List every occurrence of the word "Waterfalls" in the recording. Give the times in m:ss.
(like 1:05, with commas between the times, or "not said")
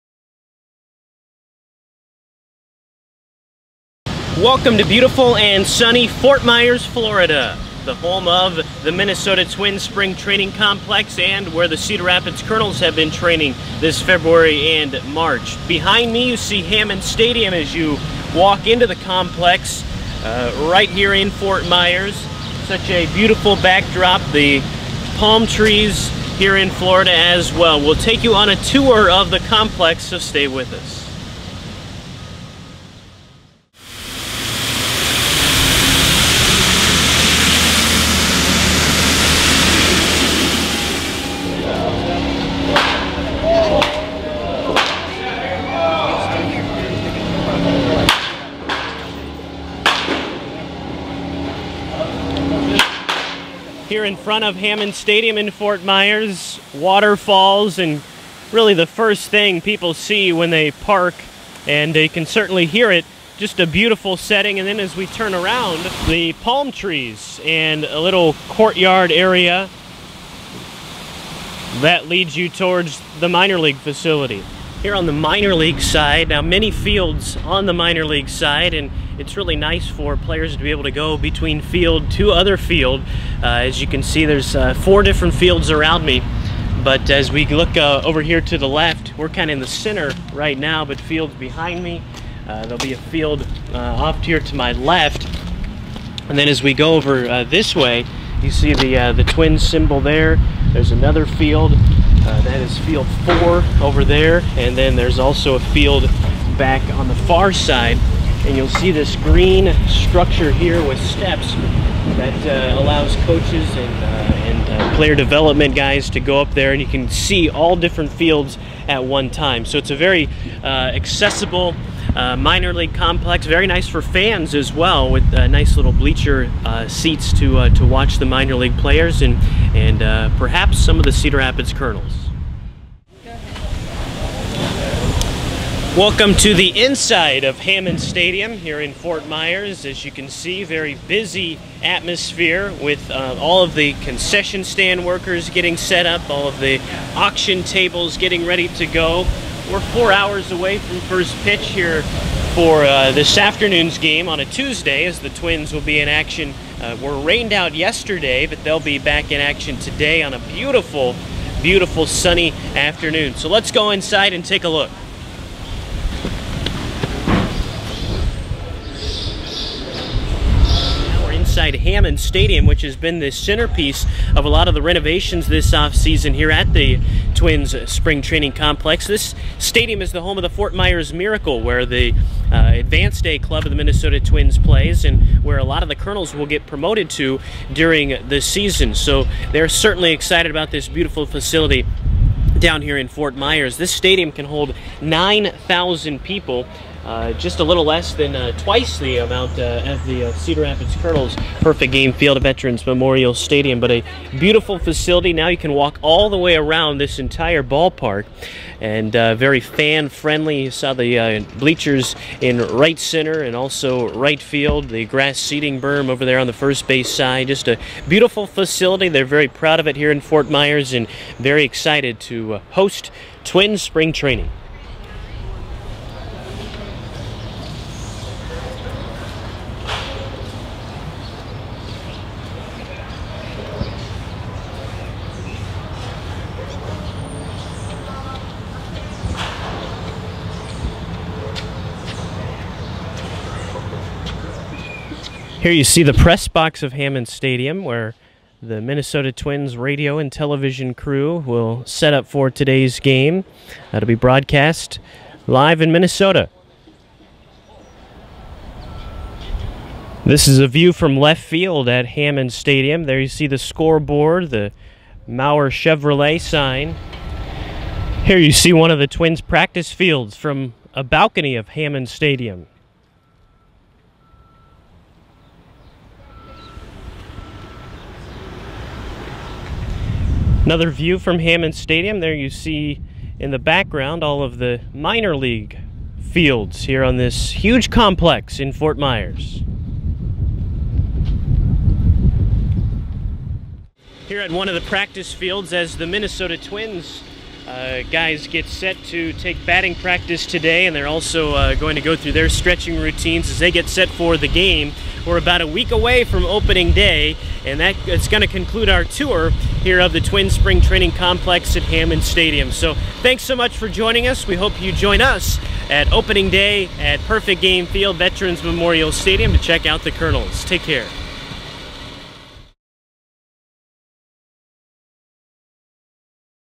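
0:56.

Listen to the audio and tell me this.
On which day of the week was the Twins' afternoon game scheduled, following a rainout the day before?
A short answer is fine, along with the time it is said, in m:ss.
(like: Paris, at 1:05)
Tuesday, at 2:34.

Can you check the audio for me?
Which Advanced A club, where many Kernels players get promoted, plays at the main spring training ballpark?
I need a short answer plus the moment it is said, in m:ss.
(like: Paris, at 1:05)
Fort Myers Miracle, at 3:00.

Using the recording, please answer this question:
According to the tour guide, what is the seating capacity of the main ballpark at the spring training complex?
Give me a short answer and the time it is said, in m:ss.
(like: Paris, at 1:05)
9,000, at 3:15.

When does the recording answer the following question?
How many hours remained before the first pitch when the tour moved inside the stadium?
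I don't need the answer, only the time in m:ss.
2:29.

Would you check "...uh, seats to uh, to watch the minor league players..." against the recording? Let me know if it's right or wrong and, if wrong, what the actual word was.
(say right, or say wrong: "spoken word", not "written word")
right.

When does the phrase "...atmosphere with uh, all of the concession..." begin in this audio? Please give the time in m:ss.
2:21.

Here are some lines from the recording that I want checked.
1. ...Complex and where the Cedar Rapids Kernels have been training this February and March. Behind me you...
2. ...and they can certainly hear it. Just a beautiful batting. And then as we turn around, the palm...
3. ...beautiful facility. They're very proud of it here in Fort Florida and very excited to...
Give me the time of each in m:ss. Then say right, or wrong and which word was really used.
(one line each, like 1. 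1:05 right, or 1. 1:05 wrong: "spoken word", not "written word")
1. 0:10 right
2. 1:01 wrong: "setting", not "batting"
3. 3:38 wrong: "Myers", not "Florida".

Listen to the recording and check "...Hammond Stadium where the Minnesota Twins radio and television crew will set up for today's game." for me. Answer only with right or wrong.
right.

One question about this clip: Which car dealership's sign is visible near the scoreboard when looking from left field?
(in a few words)
Maurer Chevrolet.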